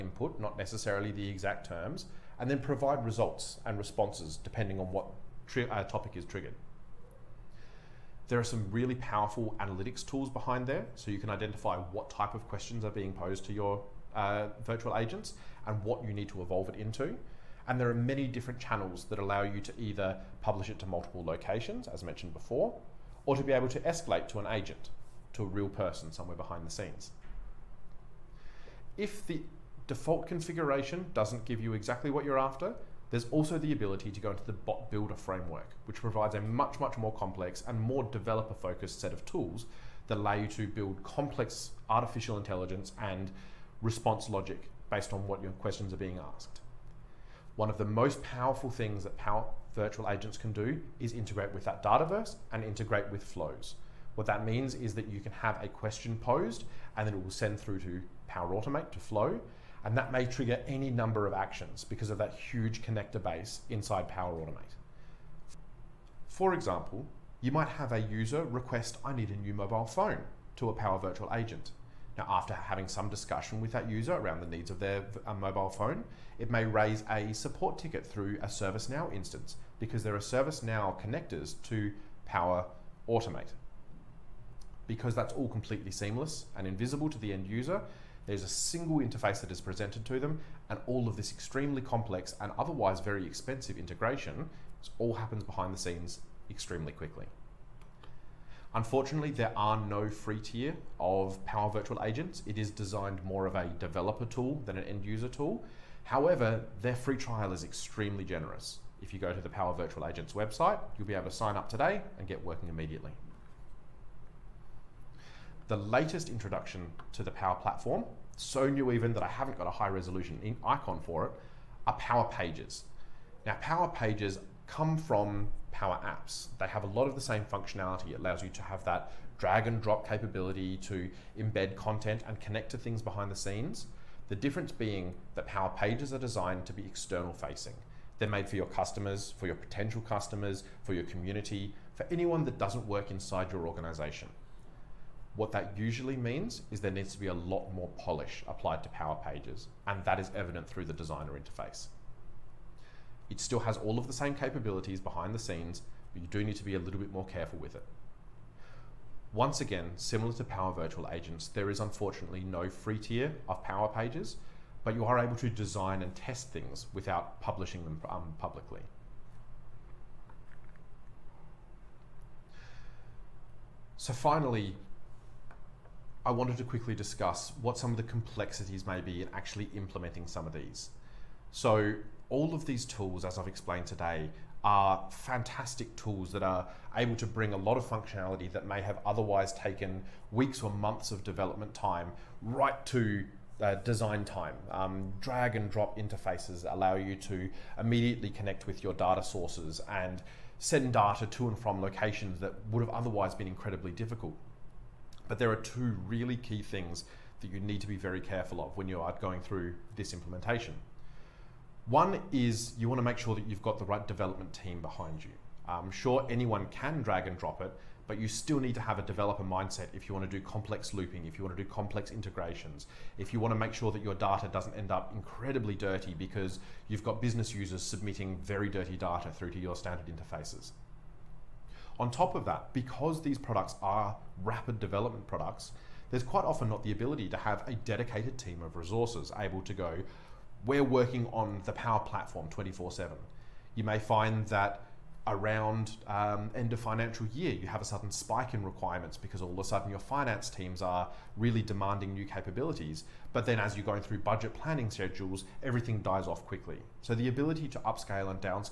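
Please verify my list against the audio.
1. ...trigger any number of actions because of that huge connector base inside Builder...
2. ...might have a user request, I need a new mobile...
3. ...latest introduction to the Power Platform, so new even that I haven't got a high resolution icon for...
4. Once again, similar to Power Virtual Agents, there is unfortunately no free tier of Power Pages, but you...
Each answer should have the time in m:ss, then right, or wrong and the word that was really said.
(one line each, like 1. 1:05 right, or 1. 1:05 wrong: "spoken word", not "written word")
1. 1:00 wrong: "Power", not "Builder"
2. 1:07 right
3. 1:55 right
4. 2:39 right.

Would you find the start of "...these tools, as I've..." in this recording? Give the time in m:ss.
3:02.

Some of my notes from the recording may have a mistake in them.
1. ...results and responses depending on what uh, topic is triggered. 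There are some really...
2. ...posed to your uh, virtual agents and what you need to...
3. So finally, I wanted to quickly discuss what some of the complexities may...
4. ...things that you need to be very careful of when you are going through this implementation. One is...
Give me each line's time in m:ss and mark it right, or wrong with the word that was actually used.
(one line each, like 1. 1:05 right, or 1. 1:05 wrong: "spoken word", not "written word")
1. 0:03 right
2. 0:13 right
3. 2:53 right
4. 3:26 right.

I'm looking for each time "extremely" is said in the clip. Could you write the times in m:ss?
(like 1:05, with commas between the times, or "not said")
1:31, 1:36, 1:47.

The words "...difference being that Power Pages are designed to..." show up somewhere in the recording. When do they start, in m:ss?
2:14.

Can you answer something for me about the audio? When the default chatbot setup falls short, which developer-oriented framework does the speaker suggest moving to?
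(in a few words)
Bot Builder framework.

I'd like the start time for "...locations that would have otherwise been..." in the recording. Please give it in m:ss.
3:21.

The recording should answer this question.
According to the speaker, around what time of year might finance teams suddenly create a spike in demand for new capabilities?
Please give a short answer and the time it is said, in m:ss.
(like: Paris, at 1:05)
End of financial year, at 4:06.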